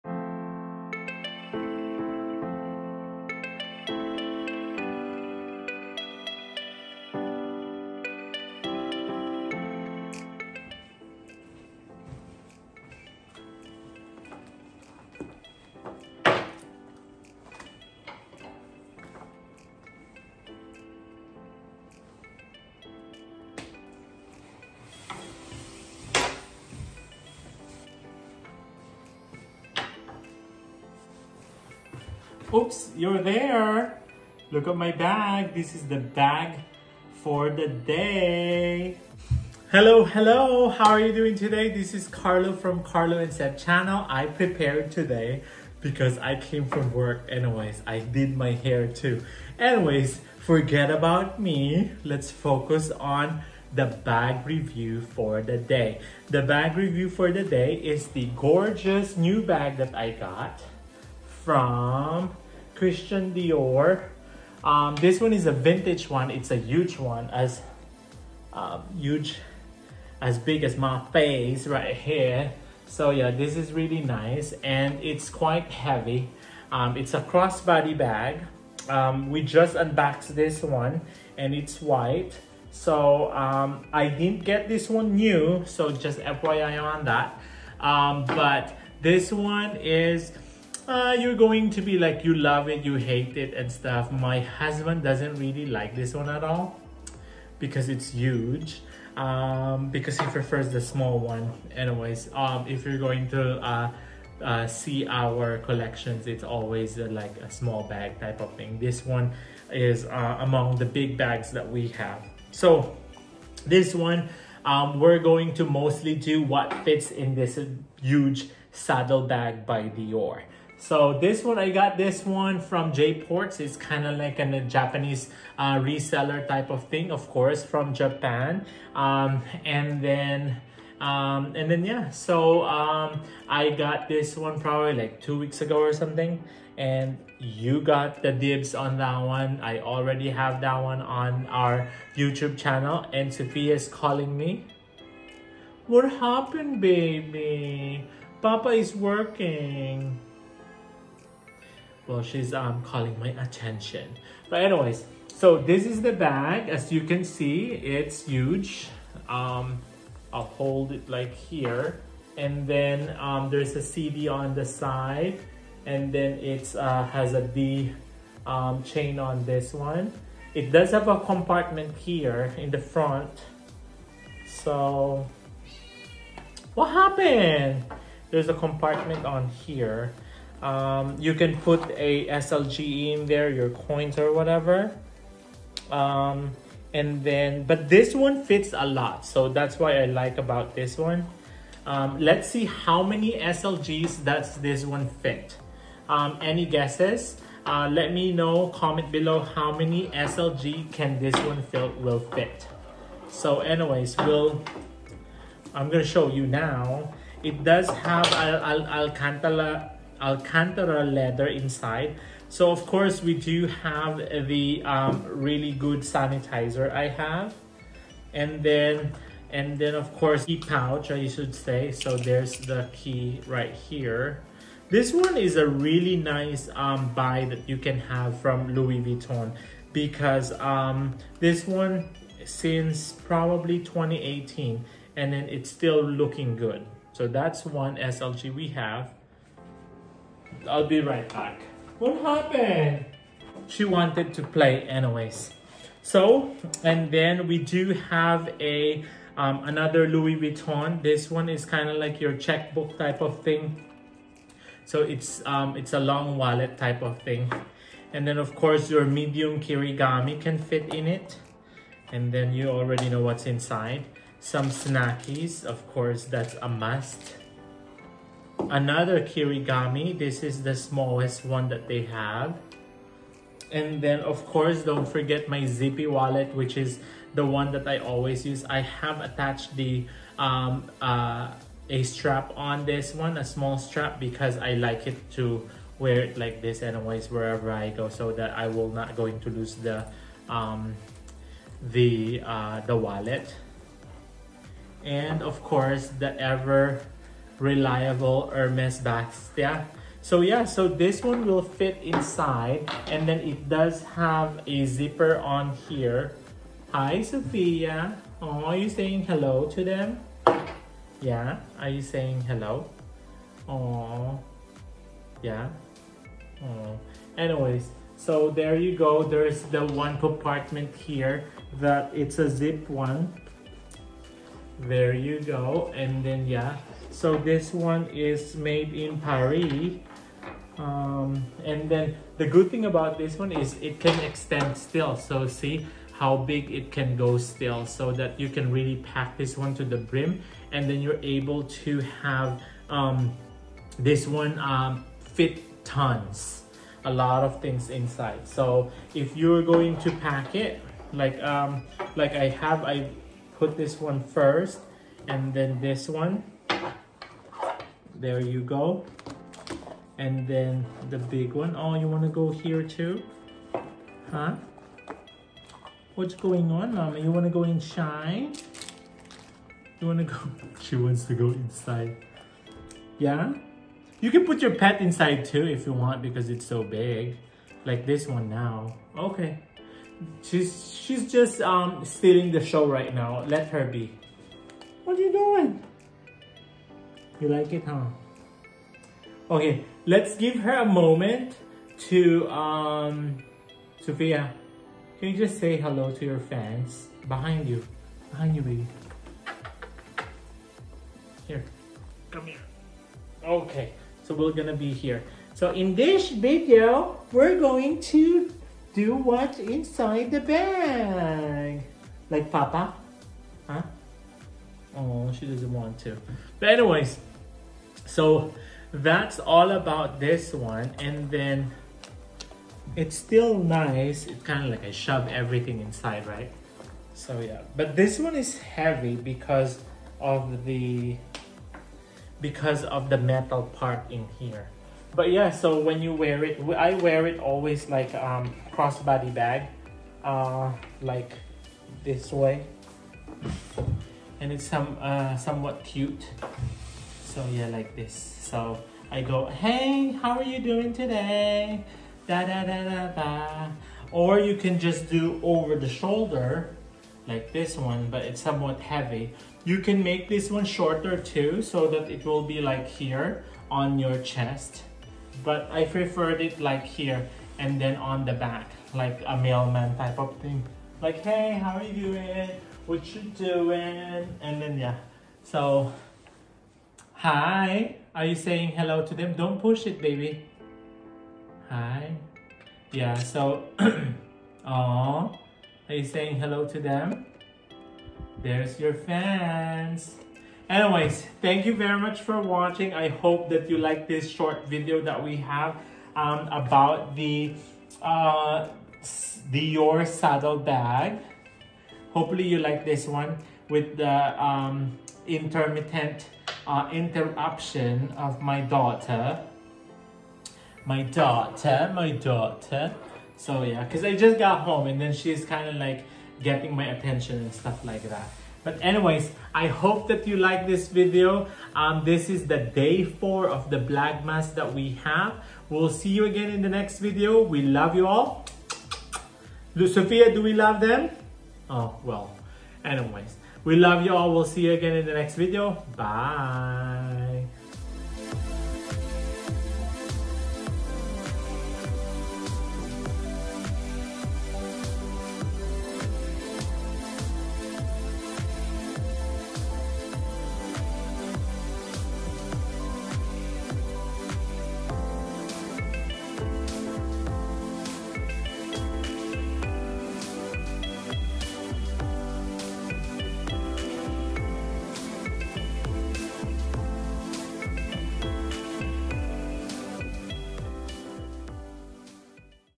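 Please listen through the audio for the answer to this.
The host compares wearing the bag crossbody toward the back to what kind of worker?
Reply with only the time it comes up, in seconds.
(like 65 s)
469 s.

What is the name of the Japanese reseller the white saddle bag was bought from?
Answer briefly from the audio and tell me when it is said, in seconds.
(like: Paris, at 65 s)
J Ports, at 122 s.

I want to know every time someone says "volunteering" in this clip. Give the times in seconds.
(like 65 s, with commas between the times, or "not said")
not said.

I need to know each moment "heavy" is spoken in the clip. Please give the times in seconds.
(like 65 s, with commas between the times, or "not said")
75 s, 428 s, 458 s.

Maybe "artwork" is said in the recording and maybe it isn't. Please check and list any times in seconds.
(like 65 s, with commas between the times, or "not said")
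not said.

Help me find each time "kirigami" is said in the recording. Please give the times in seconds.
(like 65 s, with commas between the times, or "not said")
259 s, 269 s.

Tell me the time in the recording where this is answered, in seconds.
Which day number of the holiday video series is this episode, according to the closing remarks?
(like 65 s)
522 s.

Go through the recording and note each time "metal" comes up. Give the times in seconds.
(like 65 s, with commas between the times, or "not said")
433 s.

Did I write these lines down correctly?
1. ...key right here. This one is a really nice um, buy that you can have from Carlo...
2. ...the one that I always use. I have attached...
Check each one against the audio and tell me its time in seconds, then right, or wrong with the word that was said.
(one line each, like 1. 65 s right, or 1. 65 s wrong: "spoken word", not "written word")
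1. 222 s wrong: "Louis", not "Carlo"
2. 277 s right.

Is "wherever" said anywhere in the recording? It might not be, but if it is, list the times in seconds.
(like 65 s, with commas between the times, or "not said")
287 s.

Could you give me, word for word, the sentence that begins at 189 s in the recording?
So that's why I like about this one.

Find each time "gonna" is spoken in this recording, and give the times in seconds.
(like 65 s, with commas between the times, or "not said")
205 s, 404 s.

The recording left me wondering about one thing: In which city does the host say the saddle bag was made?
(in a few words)
Paris.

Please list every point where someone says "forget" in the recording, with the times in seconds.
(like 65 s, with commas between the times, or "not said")
50 s, 275 s.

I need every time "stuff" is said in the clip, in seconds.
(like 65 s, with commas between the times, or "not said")
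93 s, 517 s.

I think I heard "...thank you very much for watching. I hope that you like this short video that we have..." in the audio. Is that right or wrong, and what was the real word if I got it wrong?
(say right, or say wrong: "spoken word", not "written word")
right.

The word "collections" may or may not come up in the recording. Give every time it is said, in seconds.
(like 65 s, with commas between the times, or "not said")
105 s.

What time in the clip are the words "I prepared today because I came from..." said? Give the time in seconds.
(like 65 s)
44 s.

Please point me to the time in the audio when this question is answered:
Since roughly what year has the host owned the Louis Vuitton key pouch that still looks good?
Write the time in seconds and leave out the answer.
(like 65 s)
233 s.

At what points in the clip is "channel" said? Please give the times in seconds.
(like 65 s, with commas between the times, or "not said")
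43 s, 142 s.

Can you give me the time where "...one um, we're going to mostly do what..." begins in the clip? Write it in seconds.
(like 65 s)
113 s.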